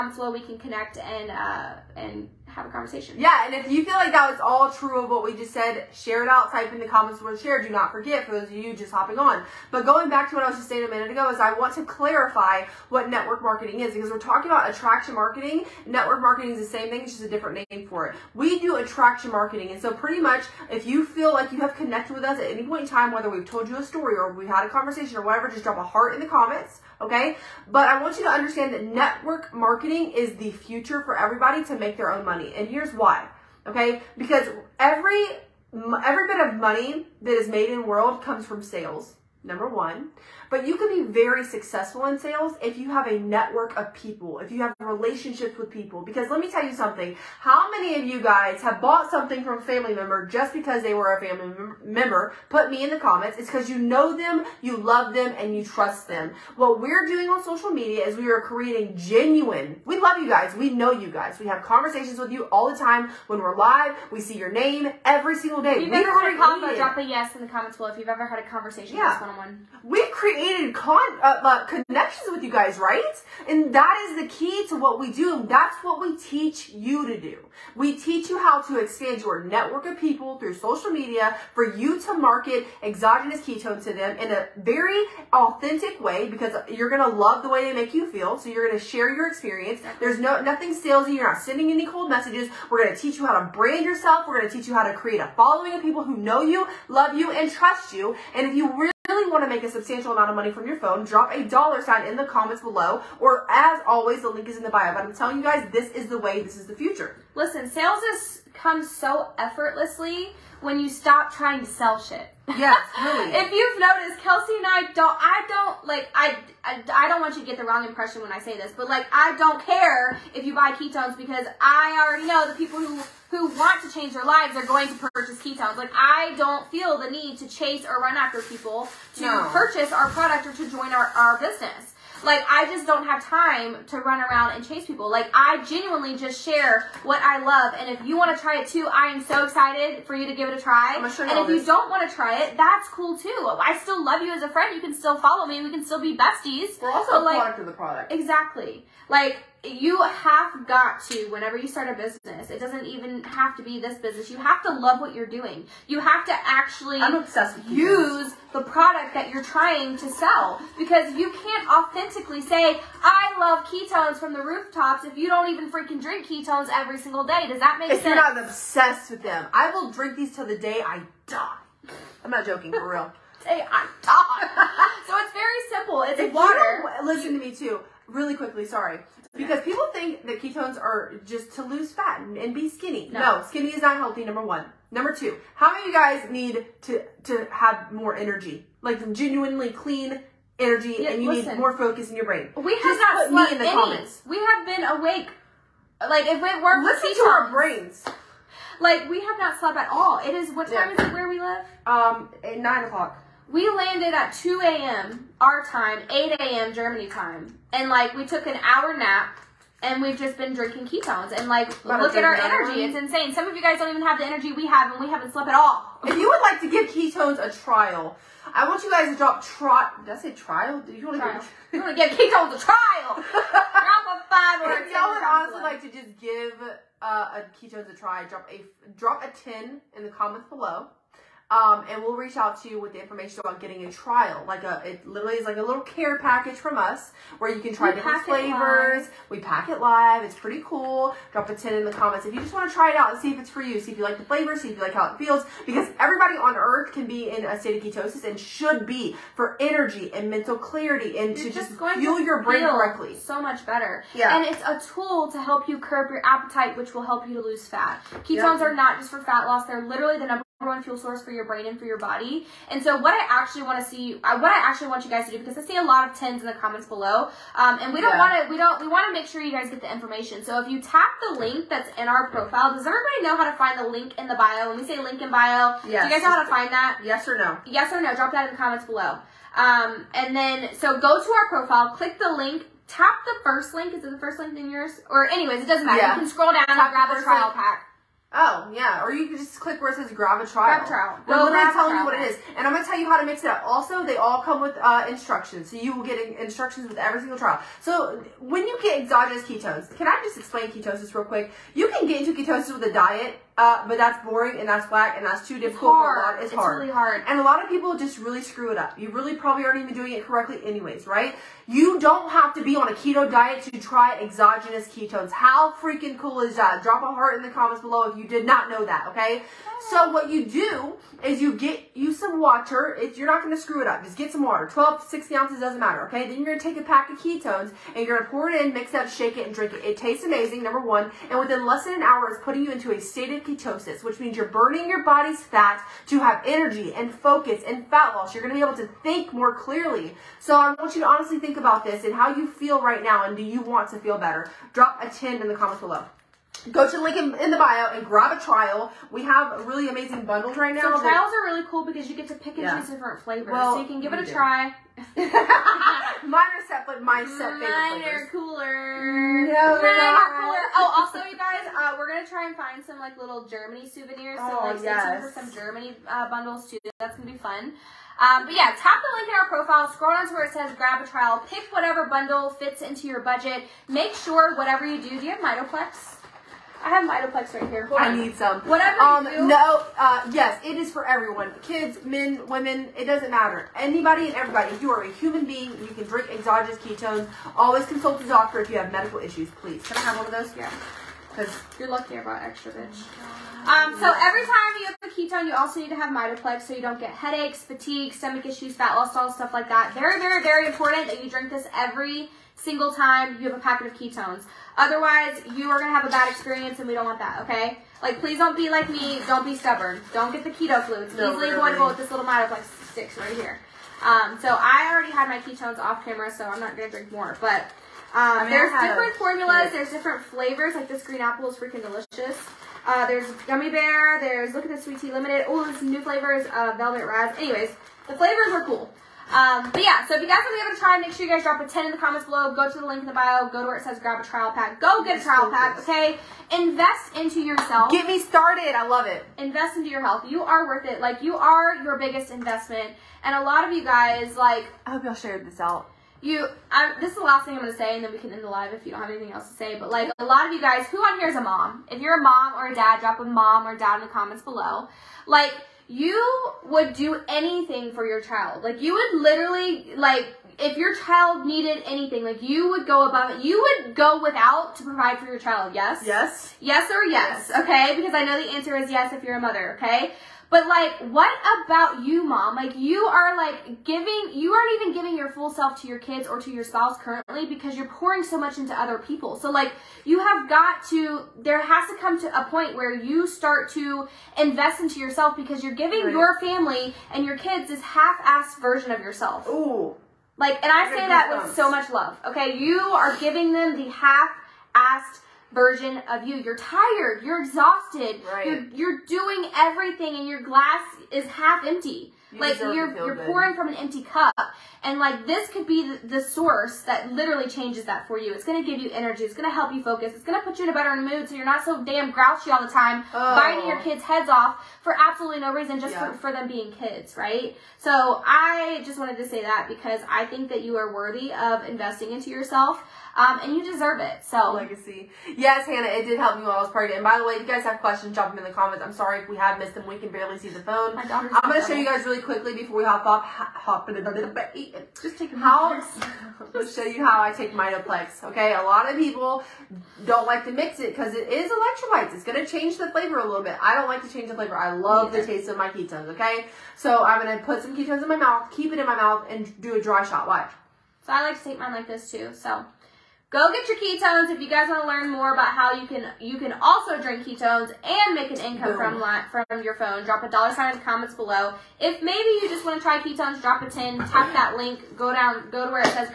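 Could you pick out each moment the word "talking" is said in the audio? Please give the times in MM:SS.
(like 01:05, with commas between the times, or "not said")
00:14.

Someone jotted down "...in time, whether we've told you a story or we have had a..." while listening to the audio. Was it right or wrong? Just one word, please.
right.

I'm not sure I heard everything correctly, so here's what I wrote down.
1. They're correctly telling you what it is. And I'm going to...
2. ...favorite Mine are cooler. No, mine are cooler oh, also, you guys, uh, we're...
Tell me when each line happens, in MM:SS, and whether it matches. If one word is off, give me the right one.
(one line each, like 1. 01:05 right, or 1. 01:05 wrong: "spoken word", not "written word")
1. 04:51 wrong: "literally", not "correctly"
2. 05:57 right.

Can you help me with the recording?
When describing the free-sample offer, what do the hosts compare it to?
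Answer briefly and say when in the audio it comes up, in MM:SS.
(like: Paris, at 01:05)
a little care package, at 03:55.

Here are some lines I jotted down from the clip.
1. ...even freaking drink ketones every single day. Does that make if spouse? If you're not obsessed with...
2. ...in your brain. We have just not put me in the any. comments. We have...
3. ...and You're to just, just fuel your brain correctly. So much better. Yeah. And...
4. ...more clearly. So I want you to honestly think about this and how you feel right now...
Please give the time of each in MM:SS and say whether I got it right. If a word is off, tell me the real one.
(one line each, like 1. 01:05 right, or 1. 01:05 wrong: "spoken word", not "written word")
1. 02:45 wrong: "sense", not "spouse"
2. 03:12 right
3. 04:11 right
4. 05:39 right.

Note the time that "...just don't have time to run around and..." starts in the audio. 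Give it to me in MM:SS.
02:12.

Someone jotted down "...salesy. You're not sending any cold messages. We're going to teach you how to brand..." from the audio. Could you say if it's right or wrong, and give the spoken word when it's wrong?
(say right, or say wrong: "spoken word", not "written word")
right.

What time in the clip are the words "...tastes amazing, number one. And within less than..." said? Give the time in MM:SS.
05:29.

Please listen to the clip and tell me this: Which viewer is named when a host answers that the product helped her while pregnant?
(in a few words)
Hannah.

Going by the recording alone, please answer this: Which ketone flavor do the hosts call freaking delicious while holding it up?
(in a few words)
green apple.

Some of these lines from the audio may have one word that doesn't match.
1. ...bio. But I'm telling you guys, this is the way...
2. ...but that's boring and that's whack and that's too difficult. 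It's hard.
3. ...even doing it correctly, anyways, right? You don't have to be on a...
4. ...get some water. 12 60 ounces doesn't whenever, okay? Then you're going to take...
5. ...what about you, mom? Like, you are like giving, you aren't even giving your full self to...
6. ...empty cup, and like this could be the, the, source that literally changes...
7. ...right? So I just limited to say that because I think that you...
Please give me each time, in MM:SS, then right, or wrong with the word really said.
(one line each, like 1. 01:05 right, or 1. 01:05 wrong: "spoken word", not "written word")
1. 01:44 right
2. 05:03 right
3. 05:09 right
4. 05:24 wrong: "matter", not "whenever"
5. 07:51 right
6. 08:23 right
7. 08:37 wrong: "wanted", not "limited".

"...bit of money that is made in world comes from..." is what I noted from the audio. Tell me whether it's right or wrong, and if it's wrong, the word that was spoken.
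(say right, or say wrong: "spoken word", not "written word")
right.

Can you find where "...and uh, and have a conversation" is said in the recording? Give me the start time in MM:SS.
00:00.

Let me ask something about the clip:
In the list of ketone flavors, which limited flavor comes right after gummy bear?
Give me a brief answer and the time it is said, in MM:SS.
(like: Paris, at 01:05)
sweet tea, at 07:04.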